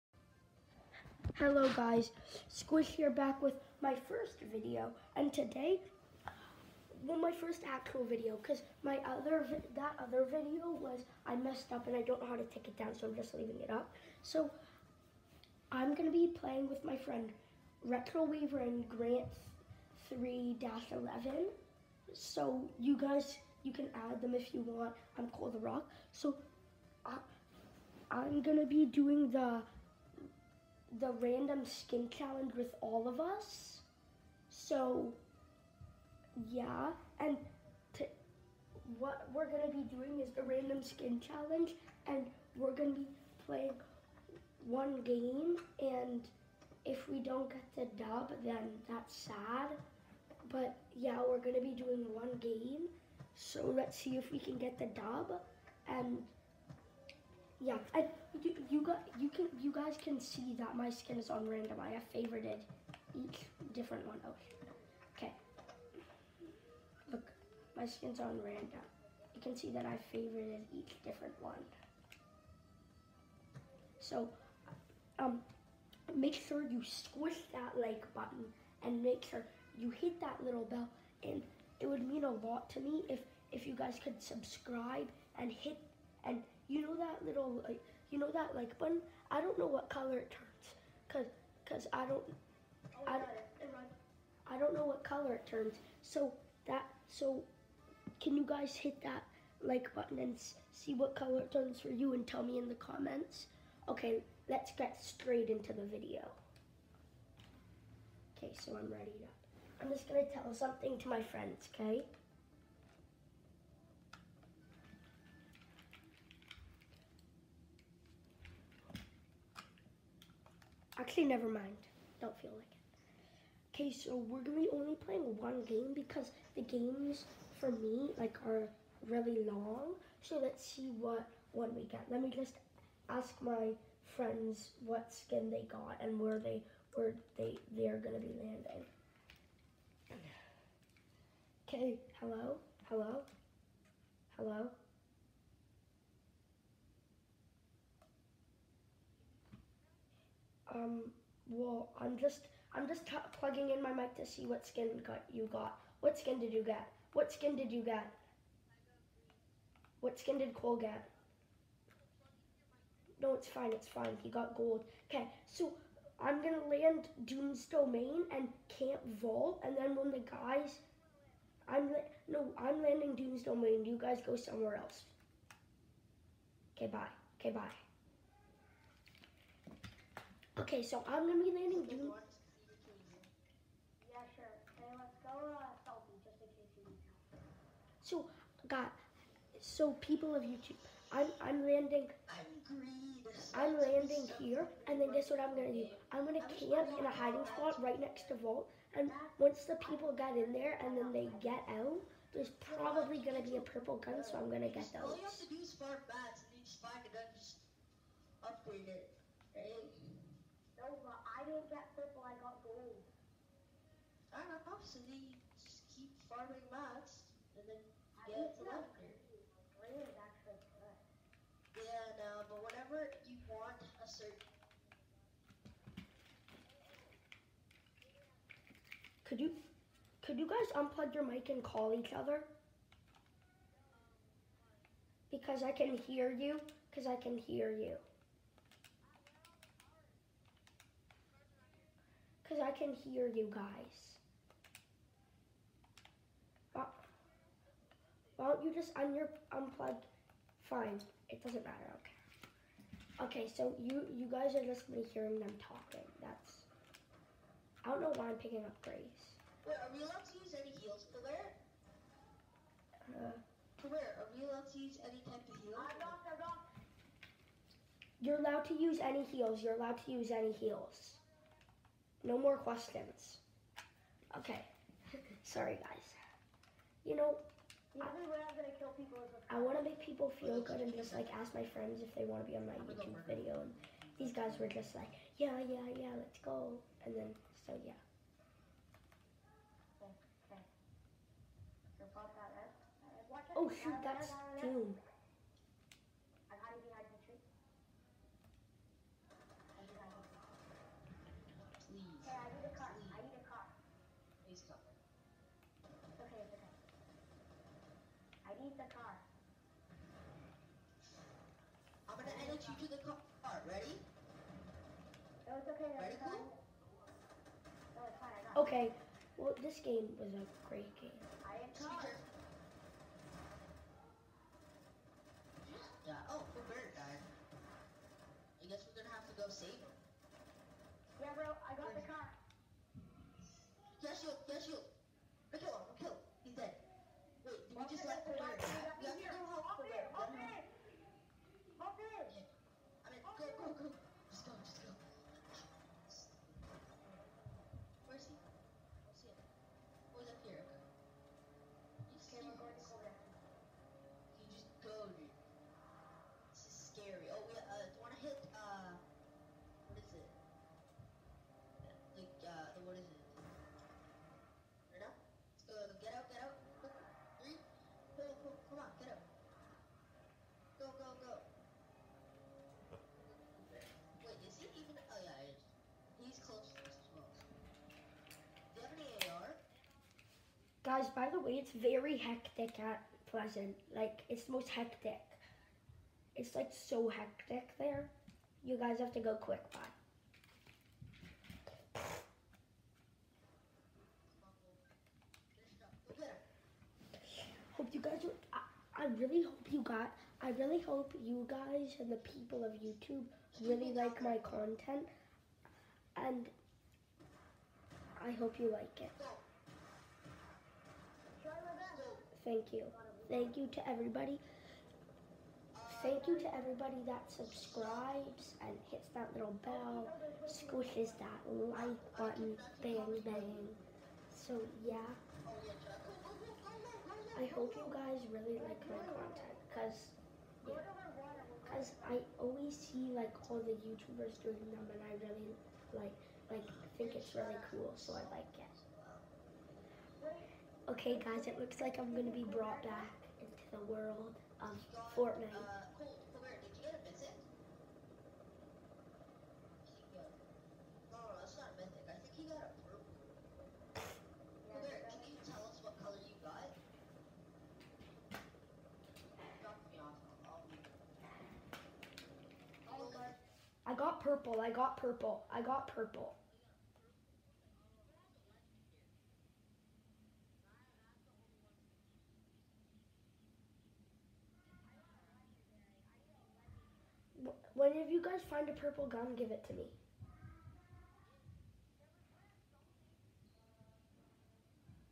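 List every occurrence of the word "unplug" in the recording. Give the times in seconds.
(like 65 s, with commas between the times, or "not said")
230 s, 249 s.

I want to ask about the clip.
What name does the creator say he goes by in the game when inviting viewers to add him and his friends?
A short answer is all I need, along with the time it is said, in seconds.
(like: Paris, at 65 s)
The Rock, at 25 s.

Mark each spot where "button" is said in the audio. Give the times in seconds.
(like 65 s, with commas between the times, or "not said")
78 s, 88 s, 99 s, 422 s.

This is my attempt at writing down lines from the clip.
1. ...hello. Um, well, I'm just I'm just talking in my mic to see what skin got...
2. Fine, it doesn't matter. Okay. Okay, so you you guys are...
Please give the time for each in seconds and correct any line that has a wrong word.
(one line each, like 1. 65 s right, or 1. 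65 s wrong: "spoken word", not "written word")
1. 144 s wrong: "plugging", not "talking"
2. 250 s right.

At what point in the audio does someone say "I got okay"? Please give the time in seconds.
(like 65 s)
318 s.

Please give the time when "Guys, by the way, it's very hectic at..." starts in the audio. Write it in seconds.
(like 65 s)
380 s.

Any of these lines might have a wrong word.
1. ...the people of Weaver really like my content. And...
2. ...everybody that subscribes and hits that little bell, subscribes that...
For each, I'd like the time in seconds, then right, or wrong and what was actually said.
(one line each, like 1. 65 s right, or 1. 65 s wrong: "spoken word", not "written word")
1. 402 s wrong: "YouTube", not "Weaver"
2. 416 s wrong: "squishes", not "subscribes".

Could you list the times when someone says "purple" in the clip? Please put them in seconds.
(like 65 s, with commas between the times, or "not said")
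203 s, 211 s, 478 s.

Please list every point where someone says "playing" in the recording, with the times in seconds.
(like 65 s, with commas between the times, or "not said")
16 s, 43 s, 124 s.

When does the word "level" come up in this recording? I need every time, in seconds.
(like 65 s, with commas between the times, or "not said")
218 s.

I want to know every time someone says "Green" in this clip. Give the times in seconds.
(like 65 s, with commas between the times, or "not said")
219 s.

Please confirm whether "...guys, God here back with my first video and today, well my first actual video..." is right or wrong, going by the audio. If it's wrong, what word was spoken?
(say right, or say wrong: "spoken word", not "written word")
wrong: "Squish", not "God".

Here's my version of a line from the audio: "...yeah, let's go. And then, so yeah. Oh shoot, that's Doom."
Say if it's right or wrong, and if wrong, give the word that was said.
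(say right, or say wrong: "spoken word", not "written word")
right.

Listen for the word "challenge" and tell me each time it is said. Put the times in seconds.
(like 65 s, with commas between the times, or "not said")
32 s, 41 s.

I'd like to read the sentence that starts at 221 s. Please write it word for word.
Yeah, no, but whenever you want a certain...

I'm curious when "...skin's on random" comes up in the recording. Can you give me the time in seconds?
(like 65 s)
67 s.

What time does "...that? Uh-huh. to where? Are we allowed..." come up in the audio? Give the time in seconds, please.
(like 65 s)
261 s.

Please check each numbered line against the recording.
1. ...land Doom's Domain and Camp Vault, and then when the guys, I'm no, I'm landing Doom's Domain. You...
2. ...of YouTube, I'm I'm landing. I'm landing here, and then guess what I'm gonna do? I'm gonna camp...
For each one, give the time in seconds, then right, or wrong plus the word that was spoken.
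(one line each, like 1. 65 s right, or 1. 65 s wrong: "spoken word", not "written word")
1. 166 s right
2. 190 s right.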